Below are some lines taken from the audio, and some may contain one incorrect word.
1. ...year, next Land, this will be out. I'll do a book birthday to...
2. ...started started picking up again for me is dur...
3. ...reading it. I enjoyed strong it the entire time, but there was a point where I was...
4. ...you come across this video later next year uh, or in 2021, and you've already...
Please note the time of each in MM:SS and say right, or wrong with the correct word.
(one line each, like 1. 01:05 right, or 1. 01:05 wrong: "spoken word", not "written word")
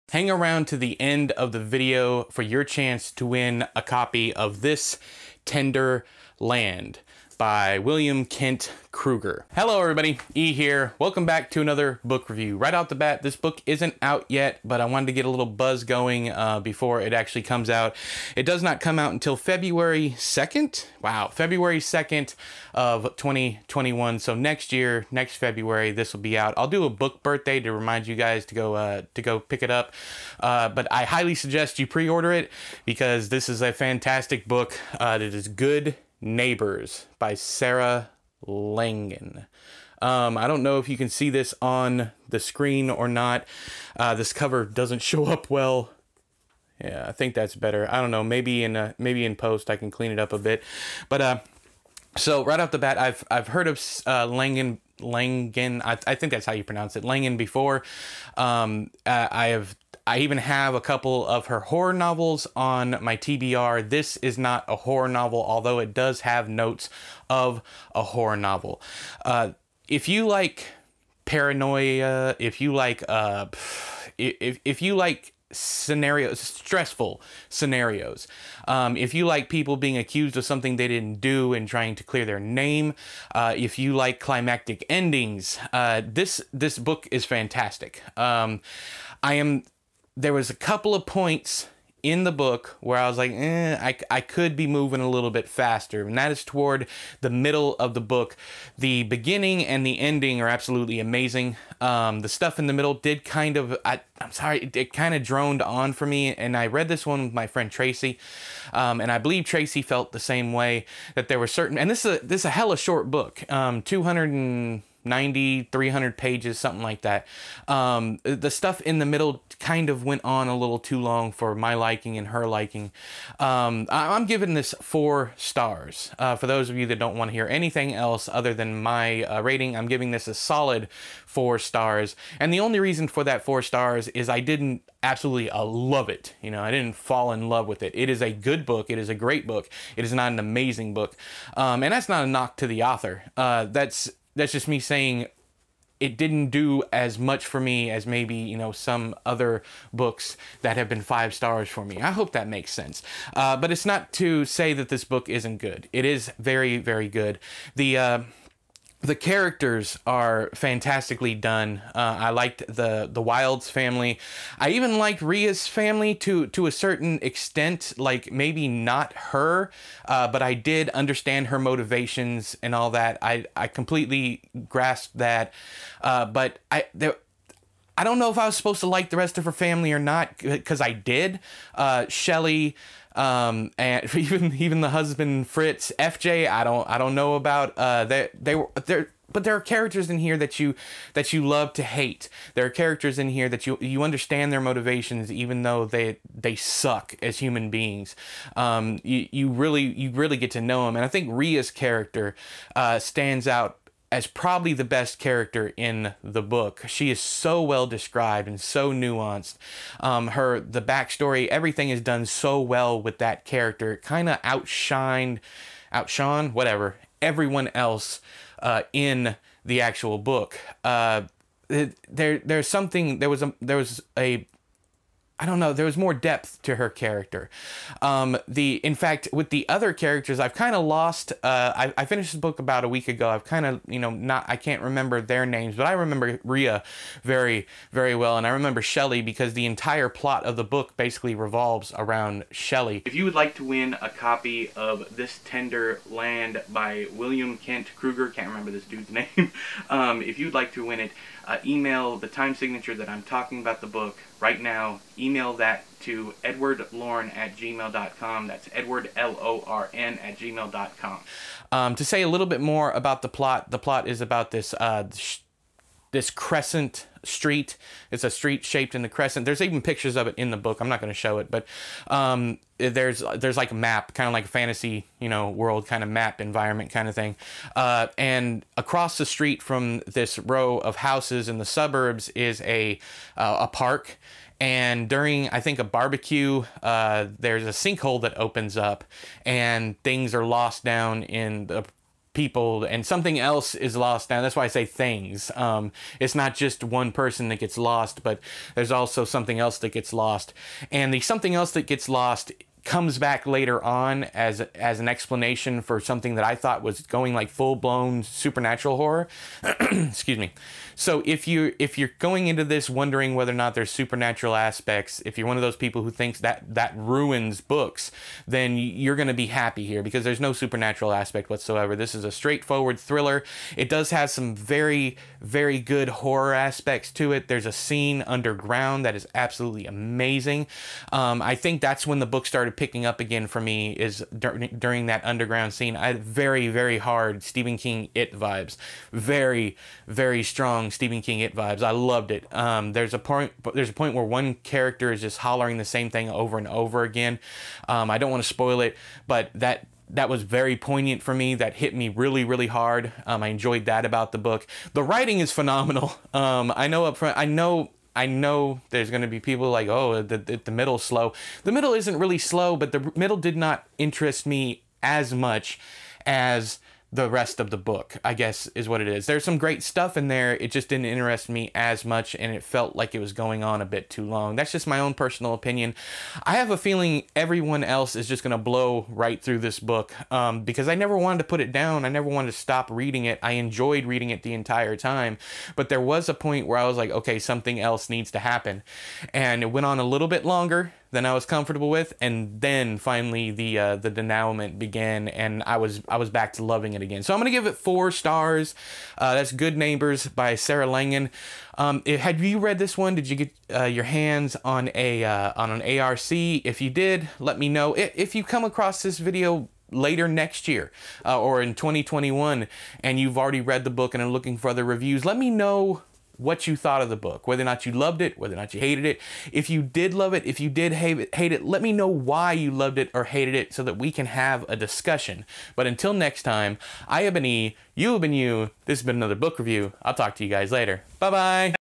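1. 00:24 wrong: "February", not "Land"
2. 05:32 right
3. 06:22 wrong: "reading", not "strong"
4. 06:48 right.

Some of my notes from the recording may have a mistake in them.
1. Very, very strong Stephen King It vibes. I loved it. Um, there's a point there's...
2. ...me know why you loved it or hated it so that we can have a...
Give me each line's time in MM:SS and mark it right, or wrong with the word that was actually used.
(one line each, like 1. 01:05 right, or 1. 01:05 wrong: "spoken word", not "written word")
1. 05:39 right
2. 07:01 right.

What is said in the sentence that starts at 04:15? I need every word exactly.
Email that to edwardlorn at gmail.com.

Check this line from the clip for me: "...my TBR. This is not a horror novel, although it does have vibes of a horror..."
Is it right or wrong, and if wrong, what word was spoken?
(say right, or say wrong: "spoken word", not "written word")
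wrong: "notes", not "vibes".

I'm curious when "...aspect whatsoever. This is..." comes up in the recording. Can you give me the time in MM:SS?
05:21.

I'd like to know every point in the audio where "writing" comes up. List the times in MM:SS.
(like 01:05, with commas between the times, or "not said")
05:55.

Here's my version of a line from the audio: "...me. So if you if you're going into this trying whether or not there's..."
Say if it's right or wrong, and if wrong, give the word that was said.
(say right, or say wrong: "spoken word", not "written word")
wrong: "wondering", not "trying".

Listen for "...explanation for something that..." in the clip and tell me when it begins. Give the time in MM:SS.
05:05.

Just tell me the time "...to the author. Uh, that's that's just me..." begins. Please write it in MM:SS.
02:22.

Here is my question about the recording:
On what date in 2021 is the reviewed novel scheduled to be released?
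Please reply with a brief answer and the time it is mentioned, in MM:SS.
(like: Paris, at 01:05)
February 2nd, at 00:21.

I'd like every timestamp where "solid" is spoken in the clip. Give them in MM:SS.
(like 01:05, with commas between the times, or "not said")
02:10.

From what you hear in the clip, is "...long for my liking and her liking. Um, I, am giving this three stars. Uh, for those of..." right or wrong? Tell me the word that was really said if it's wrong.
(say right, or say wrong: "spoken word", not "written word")
wrong: "four", not "three".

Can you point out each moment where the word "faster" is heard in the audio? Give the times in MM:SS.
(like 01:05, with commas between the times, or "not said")
01:35.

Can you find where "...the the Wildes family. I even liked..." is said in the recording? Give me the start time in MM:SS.
02:42.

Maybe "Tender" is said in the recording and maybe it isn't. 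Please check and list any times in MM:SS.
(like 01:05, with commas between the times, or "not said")
00:05, 04:05.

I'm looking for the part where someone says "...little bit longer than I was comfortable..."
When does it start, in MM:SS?
06:30.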